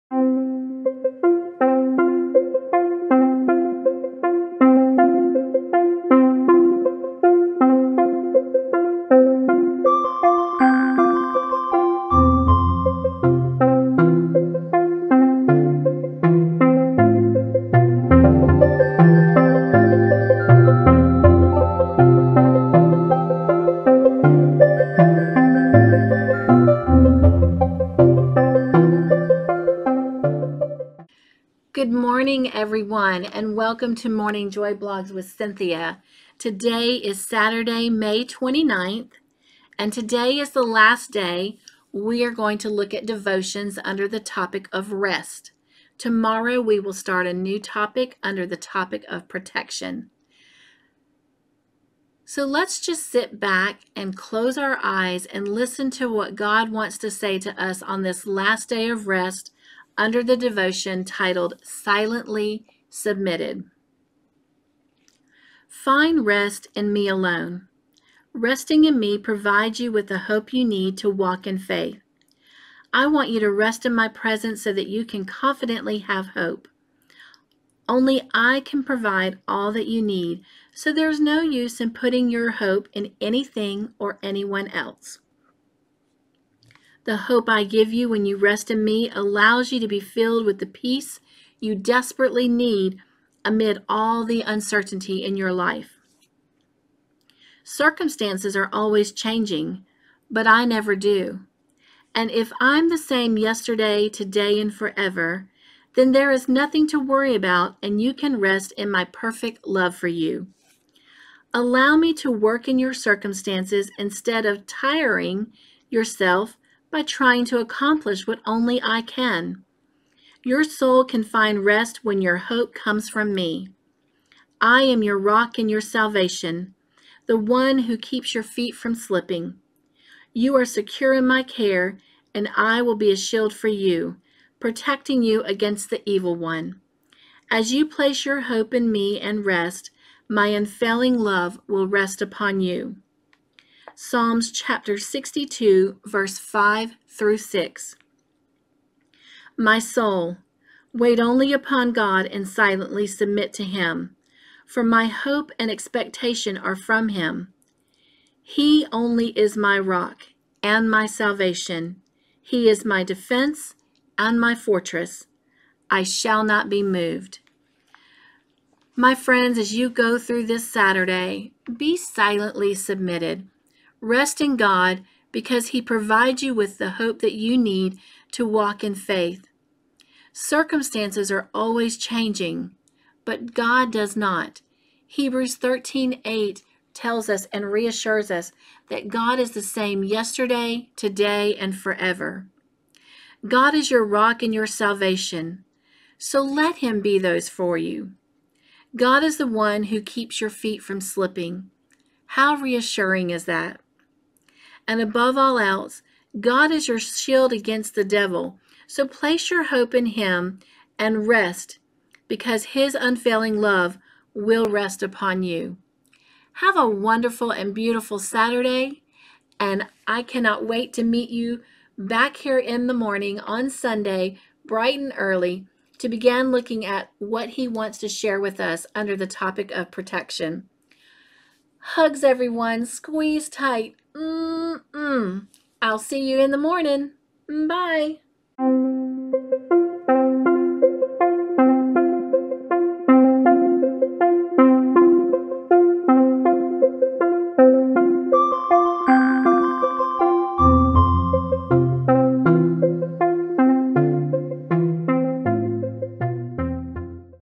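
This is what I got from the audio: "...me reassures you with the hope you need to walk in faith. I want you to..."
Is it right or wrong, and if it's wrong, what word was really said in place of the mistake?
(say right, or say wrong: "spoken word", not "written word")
wrong: "provides", not "reassures".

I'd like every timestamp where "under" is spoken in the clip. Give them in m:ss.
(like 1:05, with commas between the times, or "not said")
0:43, 0:48, 0:59, 3:48.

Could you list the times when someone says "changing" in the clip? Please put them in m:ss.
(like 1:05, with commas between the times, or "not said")
1:39, 3:01.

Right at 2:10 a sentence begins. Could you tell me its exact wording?
You are secure in my care, and I will be a shield for you, protecting you against the evil one.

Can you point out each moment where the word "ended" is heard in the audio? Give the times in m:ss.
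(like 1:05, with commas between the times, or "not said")
not said.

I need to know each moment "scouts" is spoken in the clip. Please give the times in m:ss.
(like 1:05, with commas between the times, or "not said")
not said.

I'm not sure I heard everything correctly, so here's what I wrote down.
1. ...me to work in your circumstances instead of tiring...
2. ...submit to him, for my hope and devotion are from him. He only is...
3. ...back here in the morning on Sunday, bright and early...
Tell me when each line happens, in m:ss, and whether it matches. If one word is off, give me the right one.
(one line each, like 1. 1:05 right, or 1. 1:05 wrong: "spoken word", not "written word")
1. 1:51 right
2. 2:33 wrong: "expectation", not "devotion"
3. 3:41 right.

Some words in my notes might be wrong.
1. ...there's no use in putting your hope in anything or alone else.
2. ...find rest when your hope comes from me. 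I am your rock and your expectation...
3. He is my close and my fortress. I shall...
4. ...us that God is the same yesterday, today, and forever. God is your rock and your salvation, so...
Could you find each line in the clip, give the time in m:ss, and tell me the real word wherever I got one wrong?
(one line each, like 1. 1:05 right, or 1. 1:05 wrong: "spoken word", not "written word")
1. 1:20 wrong: "anyone", not "alone"
2. 2:01 wrong: "salvation", not "expectation"
3. 2:42 wrong: "defense", not "close"
4. 3:08 right.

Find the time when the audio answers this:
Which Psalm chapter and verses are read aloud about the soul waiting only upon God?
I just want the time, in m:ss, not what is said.
2:23.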